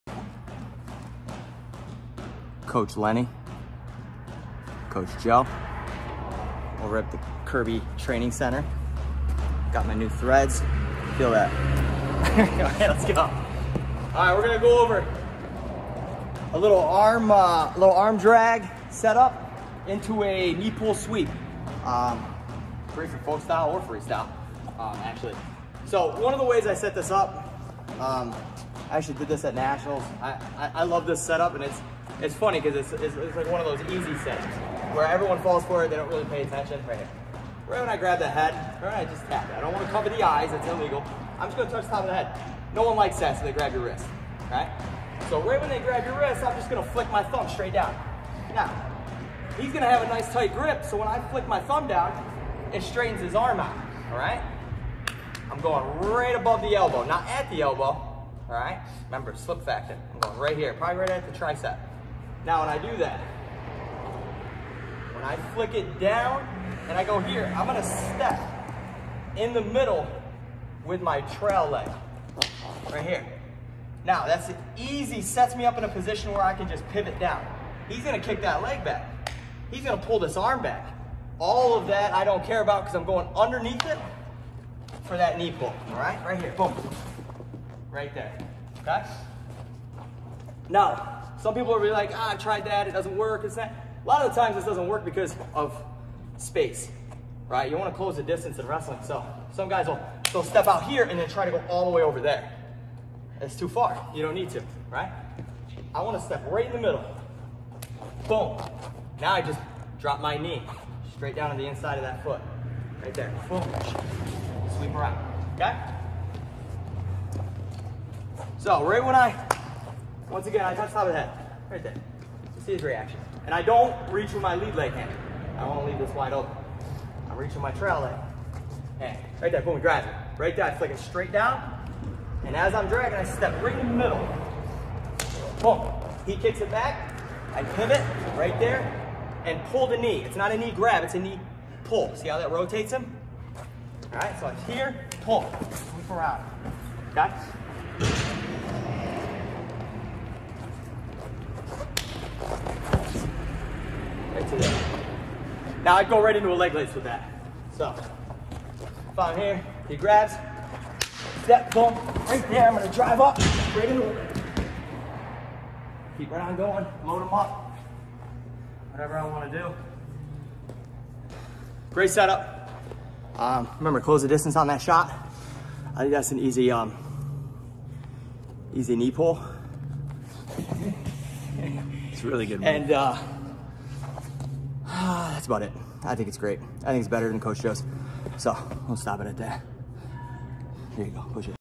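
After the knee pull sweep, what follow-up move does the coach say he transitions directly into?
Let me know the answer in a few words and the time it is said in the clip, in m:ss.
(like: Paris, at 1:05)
leg lace, at 2:36.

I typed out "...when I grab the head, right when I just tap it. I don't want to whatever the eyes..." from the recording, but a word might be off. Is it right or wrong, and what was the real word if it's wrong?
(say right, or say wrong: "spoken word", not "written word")
wrong: "cover", not "whatever".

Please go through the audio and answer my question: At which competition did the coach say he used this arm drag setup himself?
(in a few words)
Nationals.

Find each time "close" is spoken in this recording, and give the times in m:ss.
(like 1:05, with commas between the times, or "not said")
1:37, 2:54.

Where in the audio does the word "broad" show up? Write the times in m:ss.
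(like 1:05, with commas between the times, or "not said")
not said.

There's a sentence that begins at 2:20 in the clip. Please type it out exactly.
It's not a knee grab, it's a knee pull.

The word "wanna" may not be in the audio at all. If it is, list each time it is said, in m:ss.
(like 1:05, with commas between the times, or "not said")
1:37, 1:46, 2:49.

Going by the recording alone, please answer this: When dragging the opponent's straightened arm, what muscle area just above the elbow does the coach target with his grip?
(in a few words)
the tricep.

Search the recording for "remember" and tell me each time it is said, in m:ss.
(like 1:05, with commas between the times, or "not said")
0:59, 2:53.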